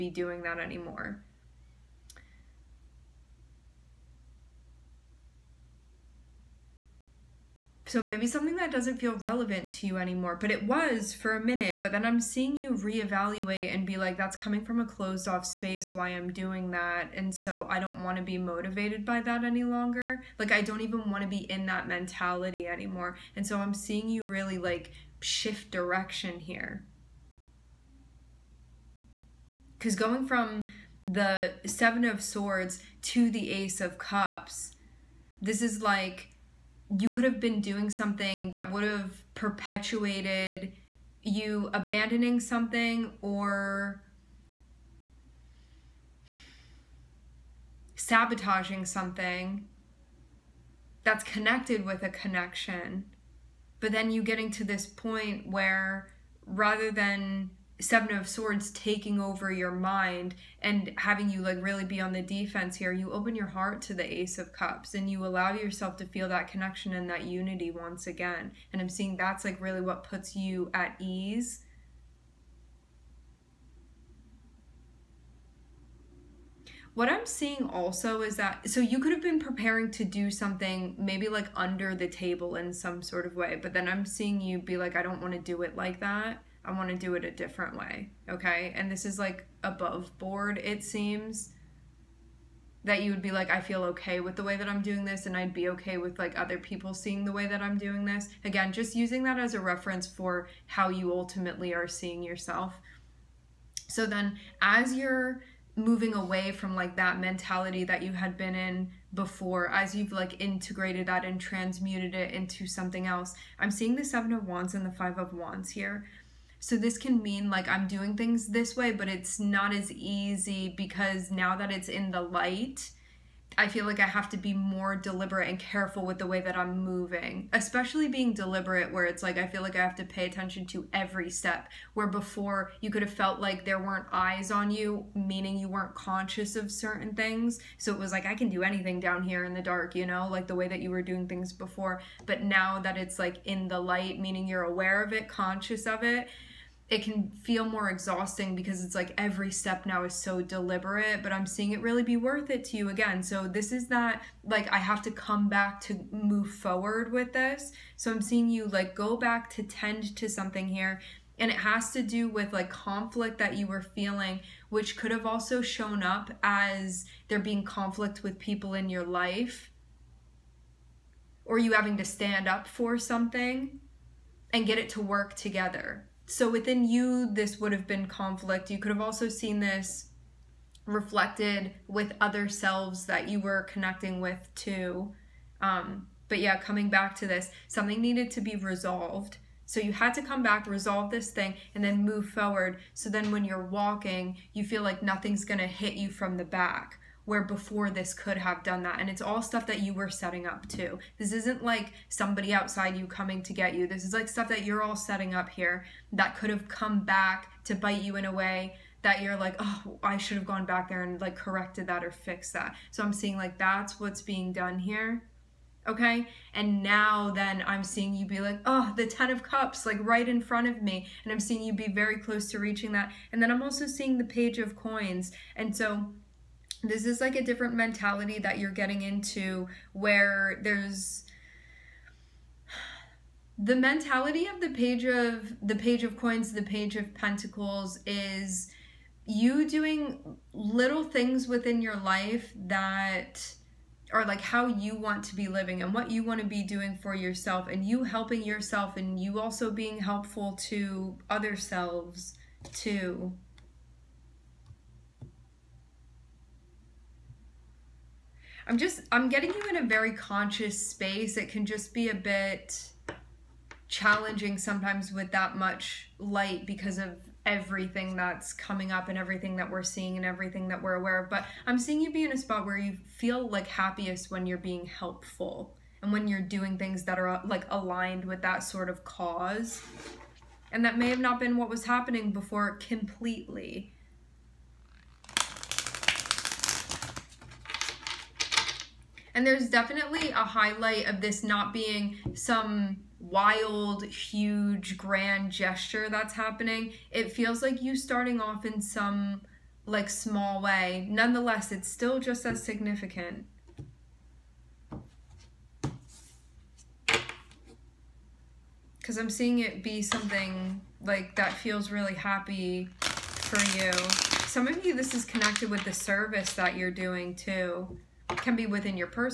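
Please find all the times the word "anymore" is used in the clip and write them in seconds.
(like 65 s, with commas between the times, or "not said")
0 s, 9 s, 22 s.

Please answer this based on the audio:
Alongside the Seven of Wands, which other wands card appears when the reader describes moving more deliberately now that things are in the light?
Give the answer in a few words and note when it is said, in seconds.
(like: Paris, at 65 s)
Five of Wands, at 114 s.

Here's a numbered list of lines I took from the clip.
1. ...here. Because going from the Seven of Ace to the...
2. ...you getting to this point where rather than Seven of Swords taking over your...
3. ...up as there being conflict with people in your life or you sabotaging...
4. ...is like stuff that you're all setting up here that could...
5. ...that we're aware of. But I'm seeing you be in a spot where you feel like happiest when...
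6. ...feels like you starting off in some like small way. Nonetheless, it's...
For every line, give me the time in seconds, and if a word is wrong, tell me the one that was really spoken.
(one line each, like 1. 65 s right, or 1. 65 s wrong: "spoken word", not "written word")
1. 26 s wrong: "Swords", not "Ace"
2. 54 s right
3. 166 s wrong: "having", not "sabotaging"
4. 204 s right
5. 270 s right
6. 297 s right.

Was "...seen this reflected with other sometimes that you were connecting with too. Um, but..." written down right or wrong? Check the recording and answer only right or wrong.
wrong.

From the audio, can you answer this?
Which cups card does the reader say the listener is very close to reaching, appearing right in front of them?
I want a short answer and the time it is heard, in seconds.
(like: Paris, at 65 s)
10 of Cups, at 219 s.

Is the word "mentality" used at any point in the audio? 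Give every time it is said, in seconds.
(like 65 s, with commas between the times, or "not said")
21 s, 107 s, 227 s, 233 s.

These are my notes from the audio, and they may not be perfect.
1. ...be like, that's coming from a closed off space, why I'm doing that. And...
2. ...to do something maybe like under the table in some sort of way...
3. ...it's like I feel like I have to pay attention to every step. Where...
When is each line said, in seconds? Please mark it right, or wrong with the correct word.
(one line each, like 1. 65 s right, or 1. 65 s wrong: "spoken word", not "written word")
1. 13 s right
2. 79 s right
3. 129 s right.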